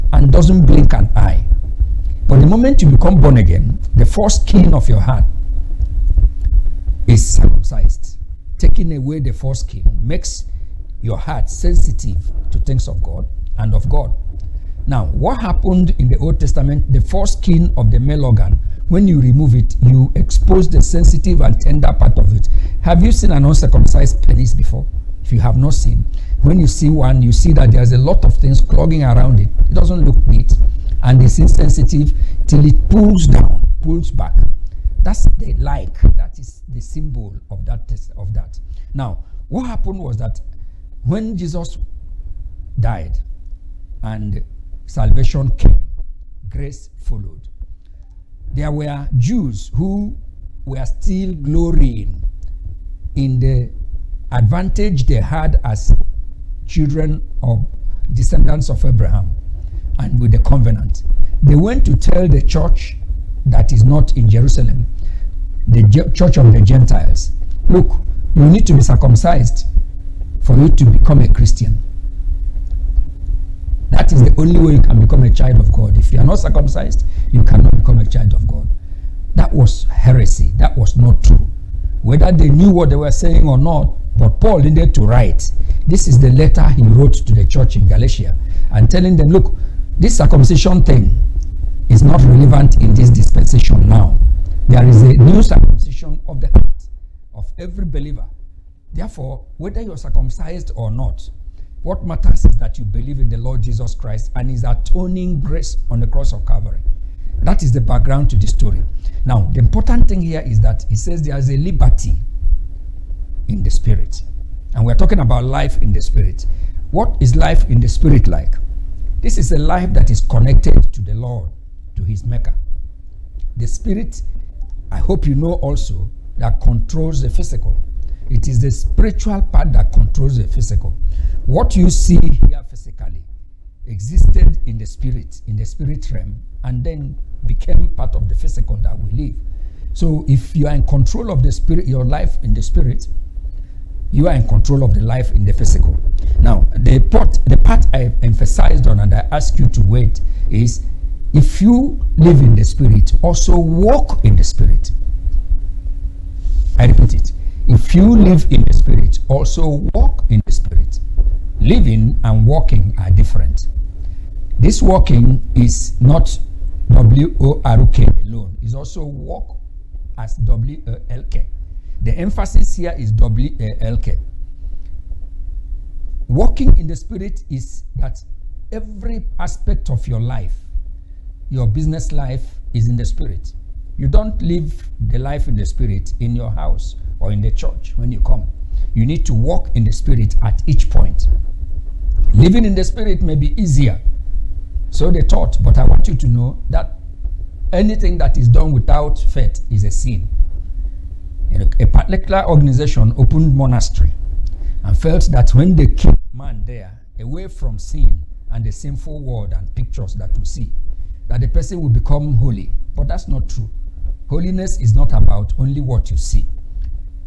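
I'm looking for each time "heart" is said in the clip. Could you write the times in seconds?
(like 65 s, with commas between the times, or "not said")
5 s, 11 s, 96 s.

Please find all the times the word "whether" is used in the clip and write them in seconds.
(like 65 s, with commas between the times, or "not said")
82 s, 99 s.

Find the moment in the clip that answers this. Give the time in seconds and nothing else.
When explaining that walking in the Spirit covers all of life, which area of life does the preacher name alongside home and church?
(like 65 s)
181 s.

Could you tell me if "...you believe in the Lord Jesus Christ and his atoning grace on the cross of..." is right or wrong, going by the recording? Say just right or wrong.
right.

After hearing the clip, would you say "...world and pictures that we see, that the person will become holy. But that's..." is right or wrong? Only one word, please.
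right.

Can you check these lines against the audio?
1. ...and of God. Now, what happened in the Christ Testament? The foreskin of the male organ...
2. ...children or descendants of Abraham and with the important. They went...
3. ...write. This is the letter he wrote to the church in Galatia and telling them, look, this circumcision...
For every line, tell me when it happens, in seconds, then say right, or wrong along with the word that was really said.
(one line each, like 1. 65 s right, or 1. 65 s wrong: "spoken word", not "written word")
1. 13 s wrong: "Old", not "Christ"
2. 56 s wrong: "covenant", not "important"
3. 85 s right.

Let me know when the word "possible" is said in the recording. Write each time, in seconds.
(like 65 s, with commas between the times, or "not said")
not said.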